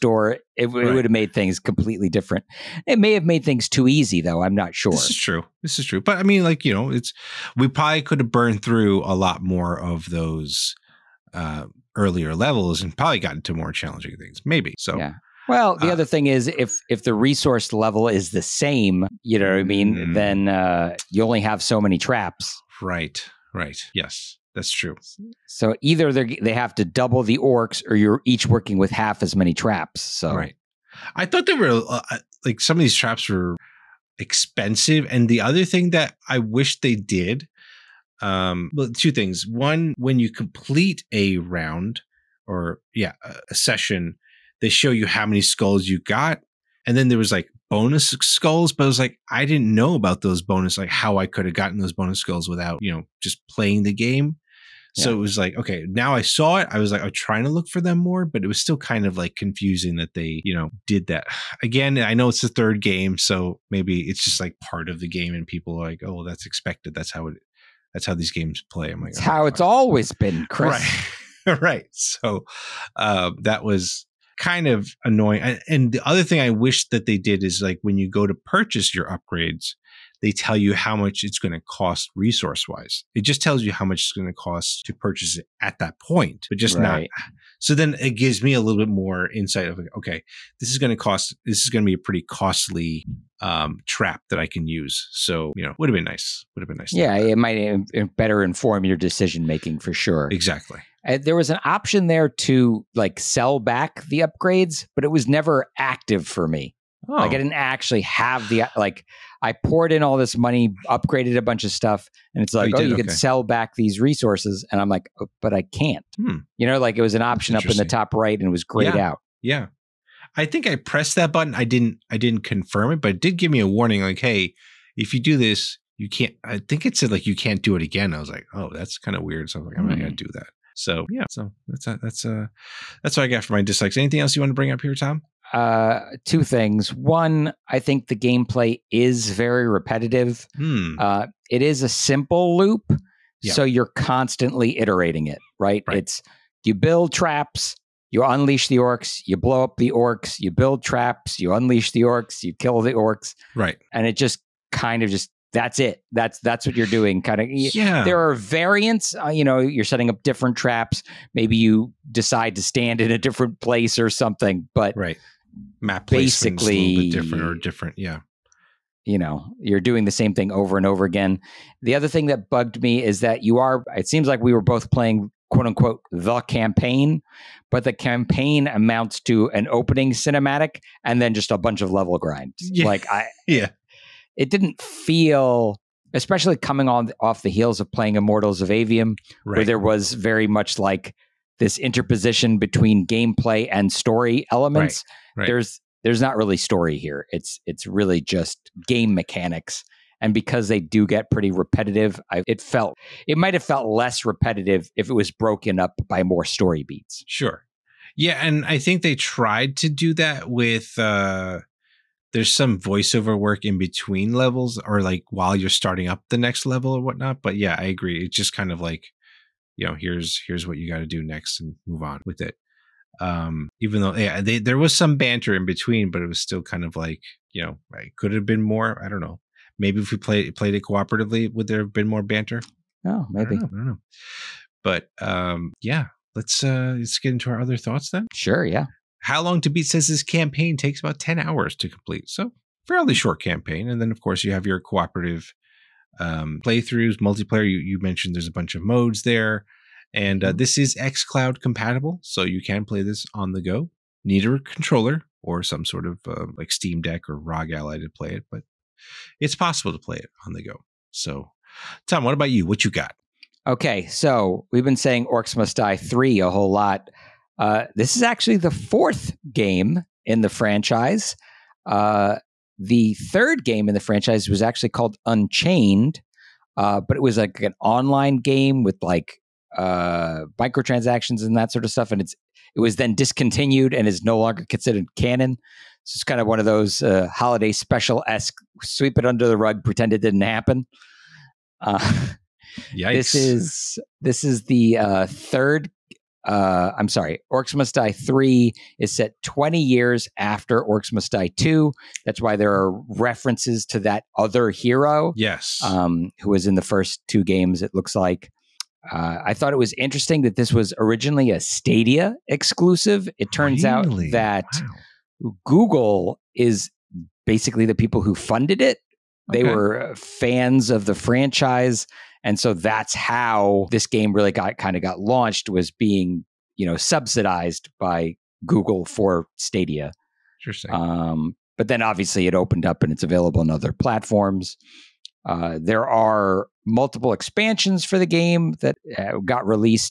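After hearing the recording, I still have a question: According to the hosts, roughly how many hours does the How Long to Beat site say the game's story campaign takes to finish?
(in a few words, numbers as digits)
10 hours.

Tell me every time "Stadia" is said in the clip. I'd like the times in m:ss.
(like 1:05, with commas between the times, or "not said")
5:11, 5:29.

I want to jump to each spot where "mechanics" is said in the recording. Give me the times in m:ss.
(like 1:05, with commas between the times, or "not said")
3:19.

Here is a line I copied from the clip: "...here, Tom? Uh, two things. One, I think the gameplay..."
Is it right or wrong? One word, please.
right.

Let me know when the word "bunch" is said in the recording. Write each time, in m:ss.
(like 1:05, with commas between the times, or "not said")
1:51, 3:01, 4:08.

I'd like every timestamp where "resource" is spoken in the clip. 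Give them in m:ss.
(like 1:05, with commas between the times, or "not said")
0:17, 1:22, 1:54.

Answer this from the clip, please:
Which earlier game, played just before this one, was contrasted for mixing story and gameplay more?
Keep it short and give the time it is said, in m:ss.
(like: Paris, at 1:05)
Immortals of Aveum, at 3:08.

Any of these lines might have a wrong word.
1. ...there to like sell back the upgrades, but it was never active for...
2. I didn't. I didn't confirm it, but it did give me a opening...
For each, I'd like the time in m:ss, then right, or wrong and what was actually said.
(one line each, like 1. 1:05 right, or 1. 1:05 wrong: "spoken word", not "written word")
1. 1:42 right
2. 2:01 wrong: "warning", not "opening".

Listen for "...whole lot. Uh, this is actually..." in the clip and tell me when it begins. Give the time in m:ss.
4:26.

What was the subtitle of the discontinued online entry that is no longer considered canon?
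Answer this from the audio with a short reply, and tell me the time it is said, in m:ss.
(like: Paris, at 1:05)
Unchained, at 4:35.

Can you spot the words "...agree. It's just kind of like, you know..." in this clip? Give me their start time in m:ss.
3:37.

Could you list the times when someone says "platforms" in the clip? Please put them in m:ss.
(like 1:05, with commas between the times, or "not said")
5:33.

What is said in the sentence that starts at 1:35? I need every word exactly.
So, you know, would have been nice.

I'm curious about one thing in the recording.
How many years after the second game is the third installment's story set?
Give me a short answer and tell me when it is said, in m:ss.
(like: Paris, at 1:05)
20 years, at 4:59.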